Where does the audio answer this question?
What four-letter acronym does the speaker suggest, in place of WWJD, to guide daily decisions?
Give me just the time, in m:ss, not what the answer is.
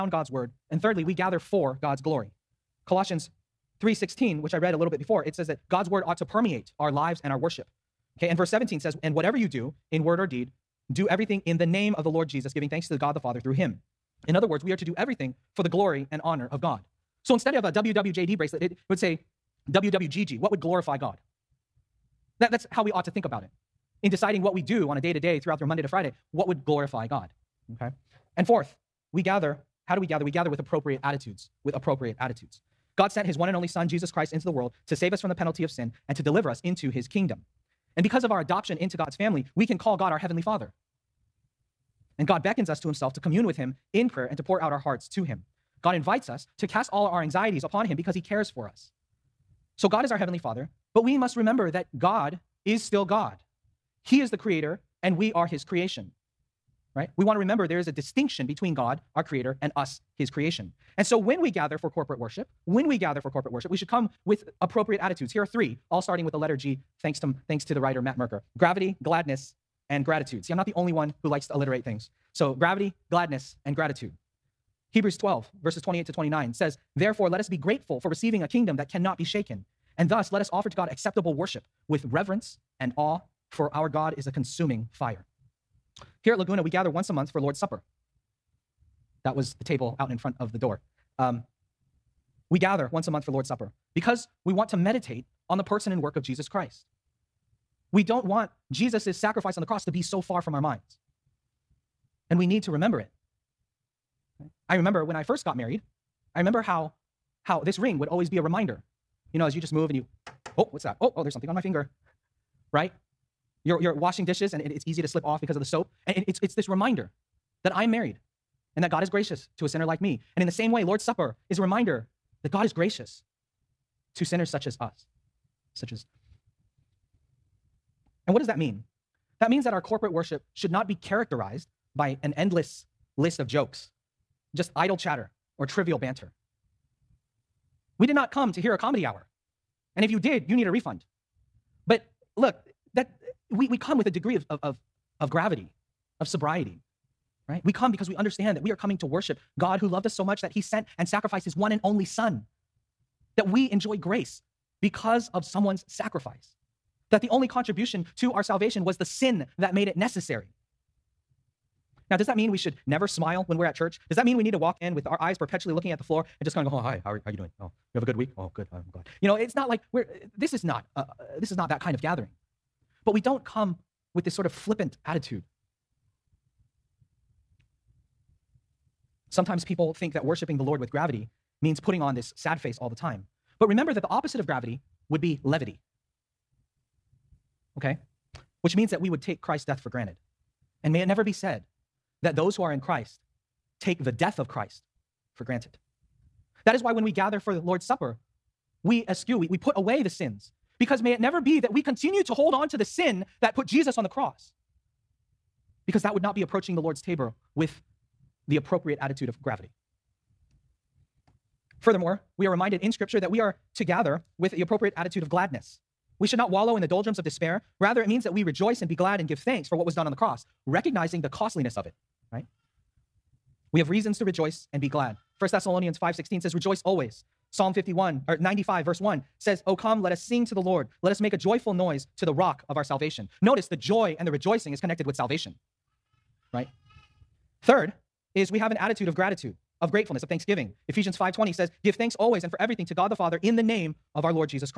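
0:19.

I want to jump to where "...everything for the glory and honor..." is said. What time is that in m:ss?
0:14.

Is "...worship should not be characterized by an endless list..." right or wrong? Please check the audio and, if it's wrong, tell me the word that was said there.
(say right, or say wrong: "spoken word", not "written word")
right.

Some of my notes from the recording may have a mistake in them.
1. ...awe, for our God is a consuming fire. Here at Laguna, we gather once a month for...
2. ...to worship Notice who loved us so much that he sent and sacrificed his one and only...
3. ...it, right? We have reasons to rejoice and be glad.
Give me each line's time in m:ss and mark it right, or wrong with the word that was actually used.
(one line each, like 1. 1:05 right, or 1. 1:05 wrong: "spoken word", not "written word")
1. 1:22 right
2. 2:28 wrong: "God", not "Notice"
3. 3:41 right.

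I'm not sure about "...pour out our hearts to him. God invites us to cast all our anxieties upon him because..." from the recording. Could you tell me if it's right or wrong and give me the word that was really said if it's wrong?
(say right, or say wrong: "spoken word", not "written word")
right.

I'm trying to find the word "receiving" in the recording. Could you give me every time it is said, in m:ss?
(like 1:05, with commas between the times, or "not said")
1:18.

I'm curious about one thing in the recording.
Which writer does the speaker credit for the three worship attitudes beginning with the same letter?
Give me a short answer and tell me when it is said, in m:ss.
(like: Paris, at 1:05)
Matt Merker, at 1:08.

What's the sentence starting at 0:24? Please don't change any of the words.
In deciding what we do on a day to day throughout your Monday to Friday, what would glorify God?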